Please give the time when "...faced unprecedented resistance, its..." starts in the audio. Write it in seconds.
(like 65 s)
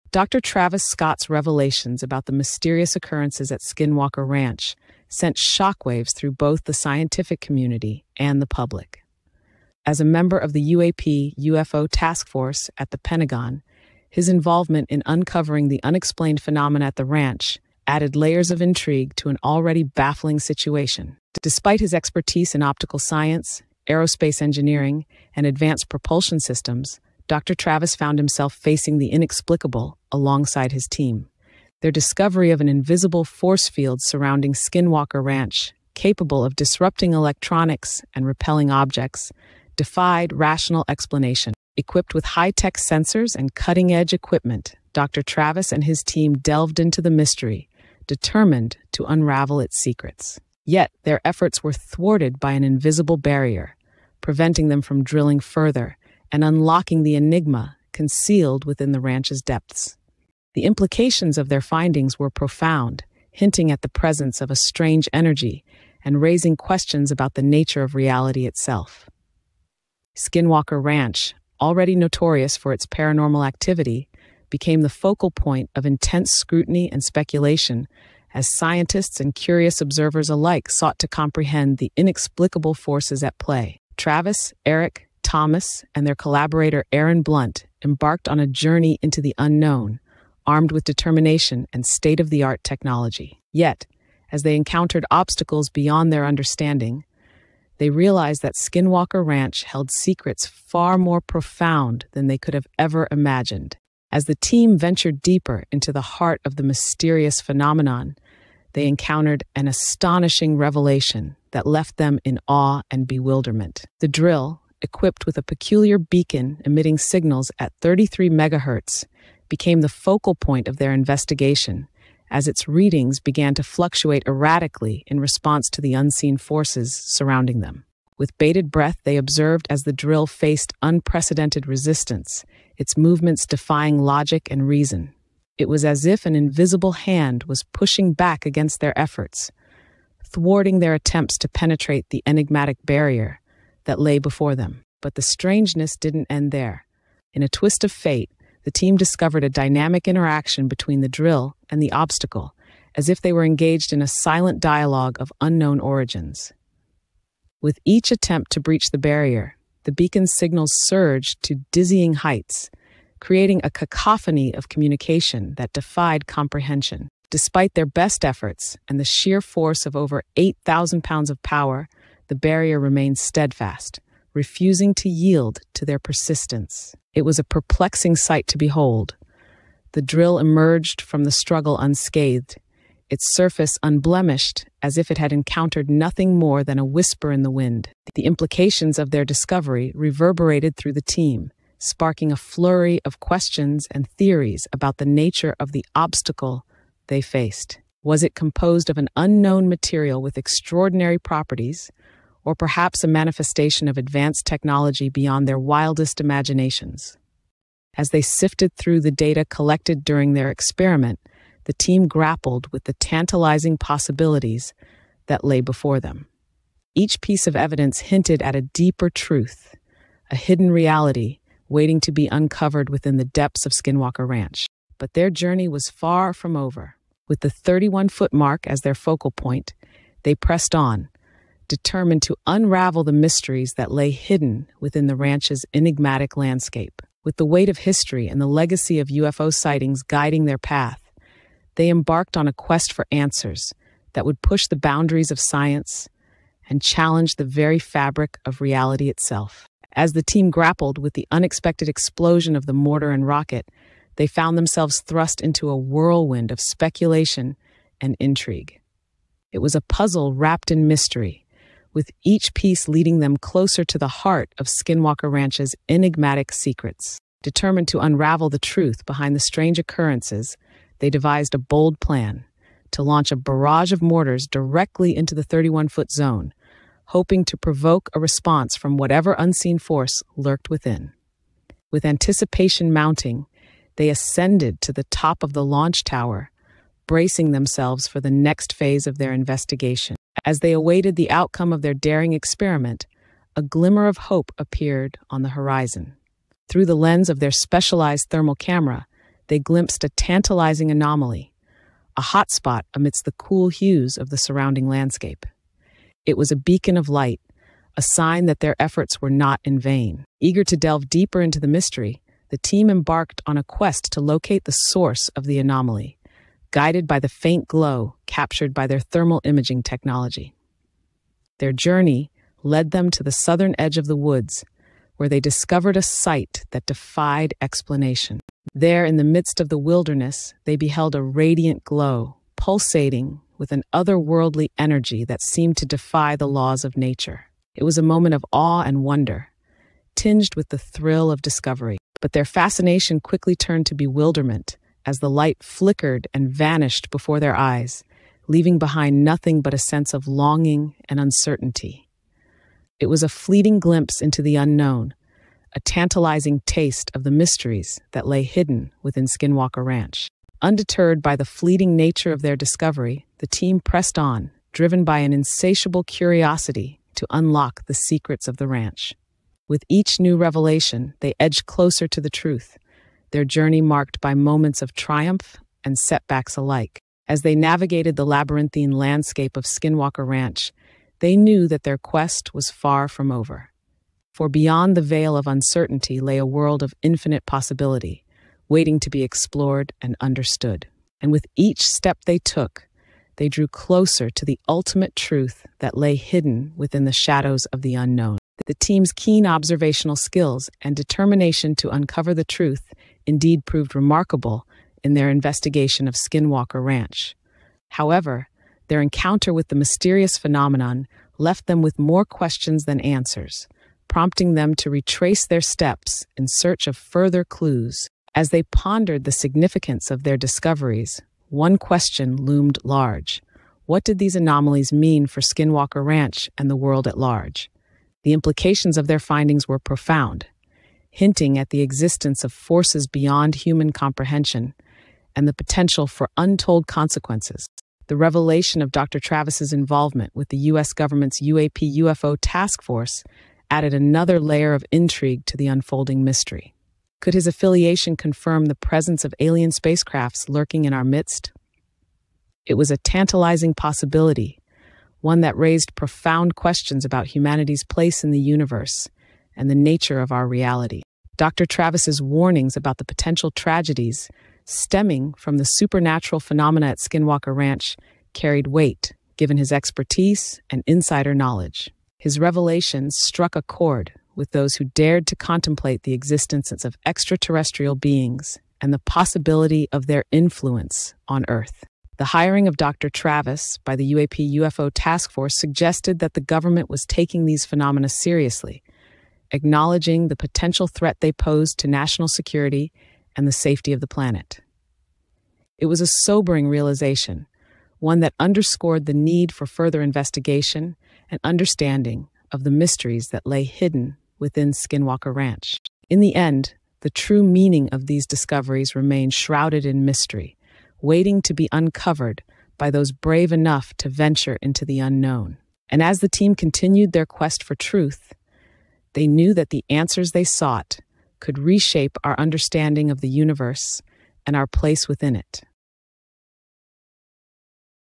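130 s.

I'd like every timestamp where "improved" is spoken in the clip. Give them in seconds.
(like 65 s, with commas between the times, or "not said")
not said.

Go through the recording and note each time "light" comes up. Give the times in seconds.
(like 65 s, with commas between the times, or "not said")
307 s, 345 s.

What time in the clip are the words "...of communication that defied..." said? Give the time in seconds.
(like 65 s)
164 s.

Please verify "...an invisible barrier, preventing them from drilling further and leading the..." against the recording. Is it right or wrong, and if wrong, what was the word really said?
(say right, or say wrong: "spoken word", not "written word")
wrong: "unlocking", not "leading".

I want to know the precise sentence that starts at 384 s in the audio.
For beyond the veil of uncertainty lay a world of infinite possibility, waiting to be explored and understood.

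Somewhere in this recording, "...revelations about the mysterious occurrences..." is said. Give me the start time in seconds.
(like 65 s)
1 s.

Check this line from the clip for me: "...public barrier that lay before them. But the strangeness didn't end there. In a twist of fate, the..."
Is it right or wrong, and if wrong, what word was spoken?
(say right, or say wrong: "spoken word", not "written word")
wrong: "enigmatic", not "public".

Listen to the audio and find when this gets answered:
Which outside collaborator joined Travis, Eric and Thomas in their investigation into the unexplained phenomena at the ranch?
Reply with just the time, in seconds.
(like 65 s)
86 s.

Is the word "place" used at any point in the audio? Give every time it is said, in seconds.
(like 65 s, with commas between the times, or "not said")
457 s, 524 s.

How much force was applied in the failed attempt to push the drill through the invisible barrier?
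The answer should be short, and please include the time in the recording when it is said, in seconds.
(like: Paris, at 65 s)
over 8,000 pounds, at 170 s.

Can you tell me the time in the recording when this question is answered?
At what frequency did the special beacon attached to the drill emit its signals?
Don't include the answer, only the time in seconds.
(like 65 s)
117 s.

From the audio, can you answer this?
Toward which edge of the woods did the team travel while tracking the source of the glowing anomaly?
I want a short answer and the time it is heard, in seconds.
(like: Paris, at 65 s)
southern edge, at 323 s.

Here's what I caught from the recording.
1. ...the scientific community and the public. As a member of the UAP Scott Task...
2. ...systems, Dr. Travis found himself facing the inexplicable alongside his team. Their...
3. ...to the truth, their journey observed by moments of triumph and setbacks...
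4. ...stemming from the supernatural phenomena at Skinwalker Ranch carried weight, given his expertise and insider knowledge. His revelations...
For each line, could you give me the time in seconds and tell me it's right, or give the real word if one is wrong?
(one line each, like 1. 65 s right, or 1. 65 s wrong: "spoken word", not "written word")
1. 6 s wrong: "UFO", not "Scott"
2. 26 s right
3. 372 s wrong: "marked", not "observed"
4. 464 s right.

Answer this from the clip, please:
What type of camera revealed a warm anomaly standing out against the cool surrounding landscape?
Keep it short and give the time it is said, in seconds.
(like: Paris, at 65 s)
thermal camera, at 298 s.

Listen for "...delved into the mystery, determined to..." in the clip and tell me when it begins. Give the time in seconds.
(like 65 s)
46 s.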